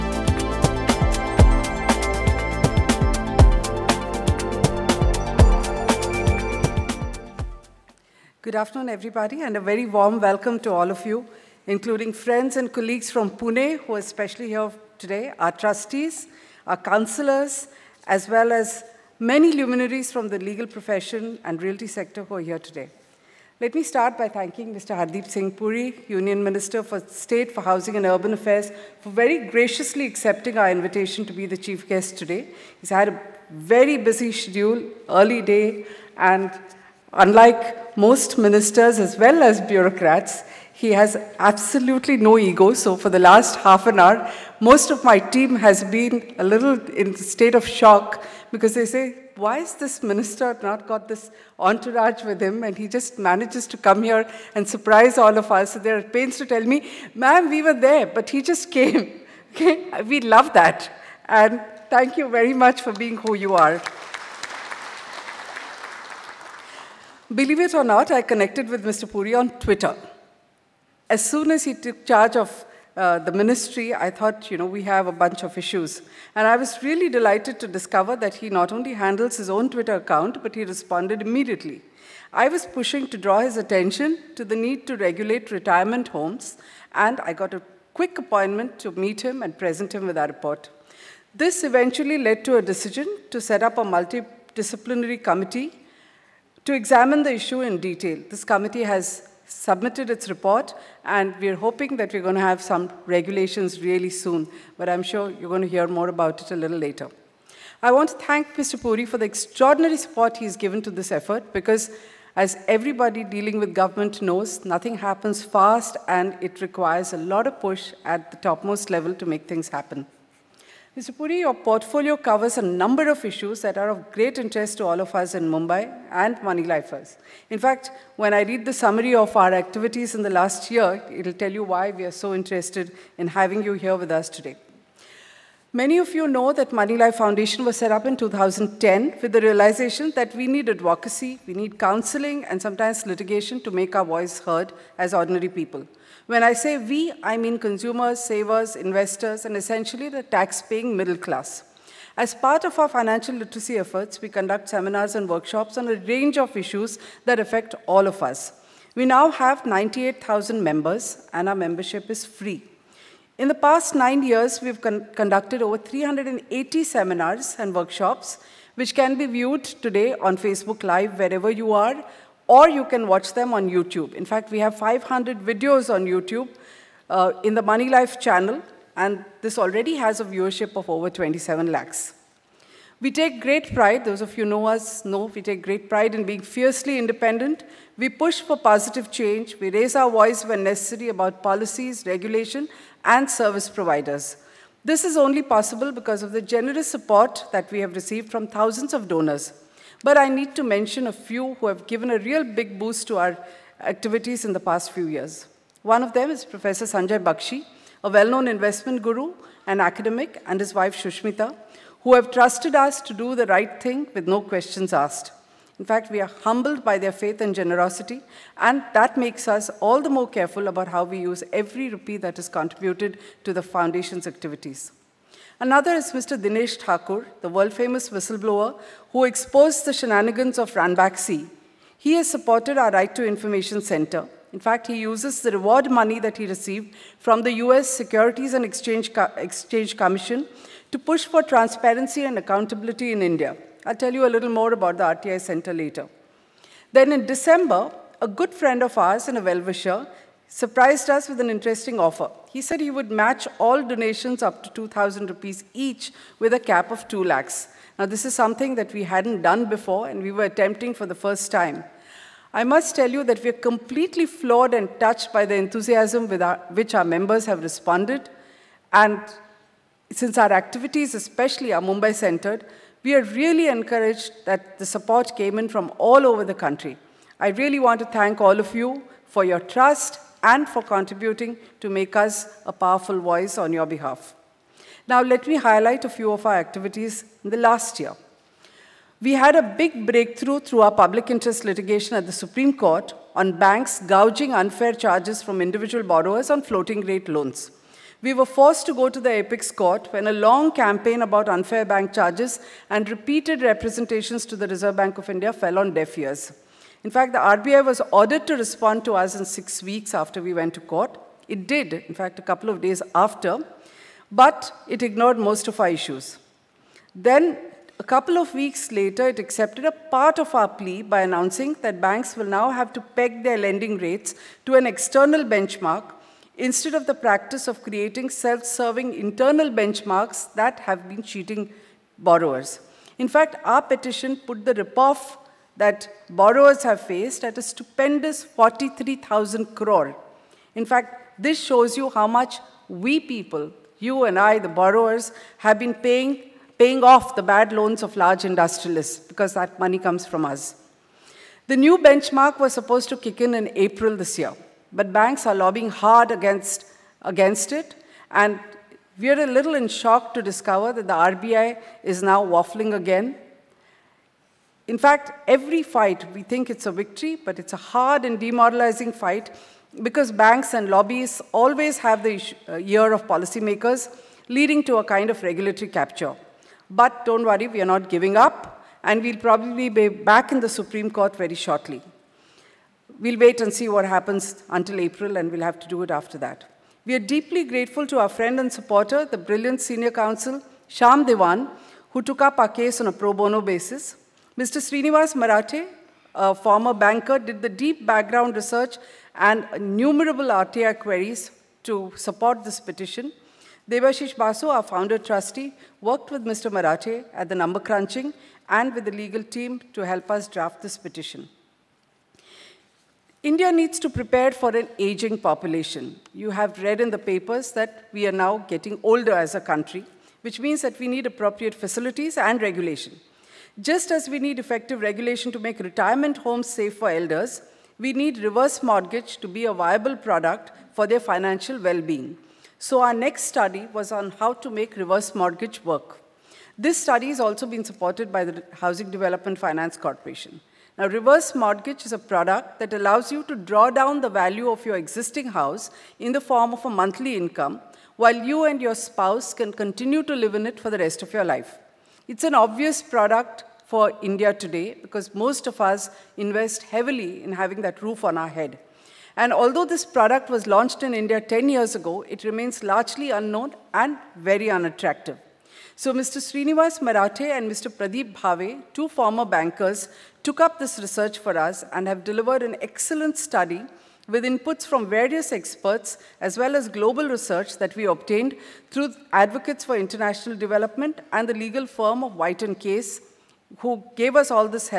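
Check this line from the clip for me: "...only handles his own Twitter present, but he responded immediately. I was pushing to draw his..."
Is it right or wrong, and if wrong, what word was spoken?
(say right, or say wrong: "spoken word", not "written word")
wrong: "account", not "present".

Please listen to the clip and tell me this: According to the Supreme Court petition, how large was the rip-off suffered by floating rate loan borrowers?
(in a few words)
43,000 crore.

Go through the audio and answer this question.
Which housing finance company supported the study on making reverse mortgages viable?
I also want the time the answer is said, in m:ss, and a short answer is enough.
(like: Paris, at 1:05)
Housing Development Finance Corporation, at 7:18.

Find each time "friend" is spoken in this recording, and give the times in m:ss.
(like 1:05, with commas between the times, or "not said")
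0:12, 4:08, 6:28.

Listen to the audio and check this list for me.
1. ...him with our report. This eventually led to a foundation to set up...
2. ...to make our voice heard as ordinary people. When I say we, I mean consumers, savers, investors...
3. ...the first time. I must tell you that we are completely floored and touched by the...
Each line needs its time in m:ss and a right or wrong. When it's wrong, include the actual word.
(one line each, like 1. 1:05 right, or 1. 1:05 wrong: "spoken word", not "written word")
1. 1:29 wrong: "decision", not "foundation"
2. 2:23 right
3. 4:21 right.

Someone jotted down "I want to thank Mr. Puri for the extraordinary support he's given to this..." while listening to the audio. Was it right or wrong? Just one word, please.
right.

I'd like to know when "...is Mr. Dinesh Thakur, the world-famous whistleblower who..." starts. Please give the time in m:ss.
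3:45.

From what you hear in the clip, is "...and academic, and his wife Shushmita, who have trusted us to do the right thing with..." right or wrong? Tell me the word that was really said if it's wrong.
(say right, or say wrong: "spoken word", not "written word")
right.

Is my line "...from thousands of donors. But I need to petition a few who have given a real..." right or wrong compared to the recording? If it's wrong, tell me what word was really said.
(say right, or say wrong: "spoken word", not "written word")
wrong: "mention", not "petition".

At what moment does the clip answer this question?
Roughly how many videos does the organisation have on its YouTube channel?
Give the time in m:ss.
2:54.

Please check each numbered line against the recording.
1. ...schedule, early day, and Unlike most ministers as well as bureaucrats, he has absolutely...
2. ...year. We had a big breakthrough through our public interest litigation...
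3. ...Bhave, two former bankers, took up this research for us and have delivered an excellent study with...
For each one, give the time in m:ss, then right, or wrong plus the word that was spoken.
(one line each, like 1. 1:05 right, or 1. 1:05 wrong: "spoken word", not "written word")
1. 0:34 right
2. 4:48 right
3. 7:48 right.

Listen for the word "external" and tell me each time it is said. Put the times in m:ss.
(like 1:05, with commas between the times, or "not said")
5:24.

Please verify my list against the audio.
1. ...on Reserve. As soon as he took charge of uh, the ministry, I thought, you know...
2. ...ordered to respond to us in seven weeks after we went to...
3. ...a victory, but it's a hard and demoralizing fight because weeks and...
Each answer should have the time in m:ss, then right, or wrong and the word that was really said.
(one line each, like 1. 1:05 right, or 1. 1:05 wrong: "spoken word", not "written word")
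1. 1:09 wrong: "Twitter", not "Reserve"
2. 5:08 wrong: "six", not "seven"
3. 6:06 wrong: "banks", not "weeks".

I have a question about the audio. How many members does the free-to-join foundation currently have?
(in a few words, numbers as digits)
98,000.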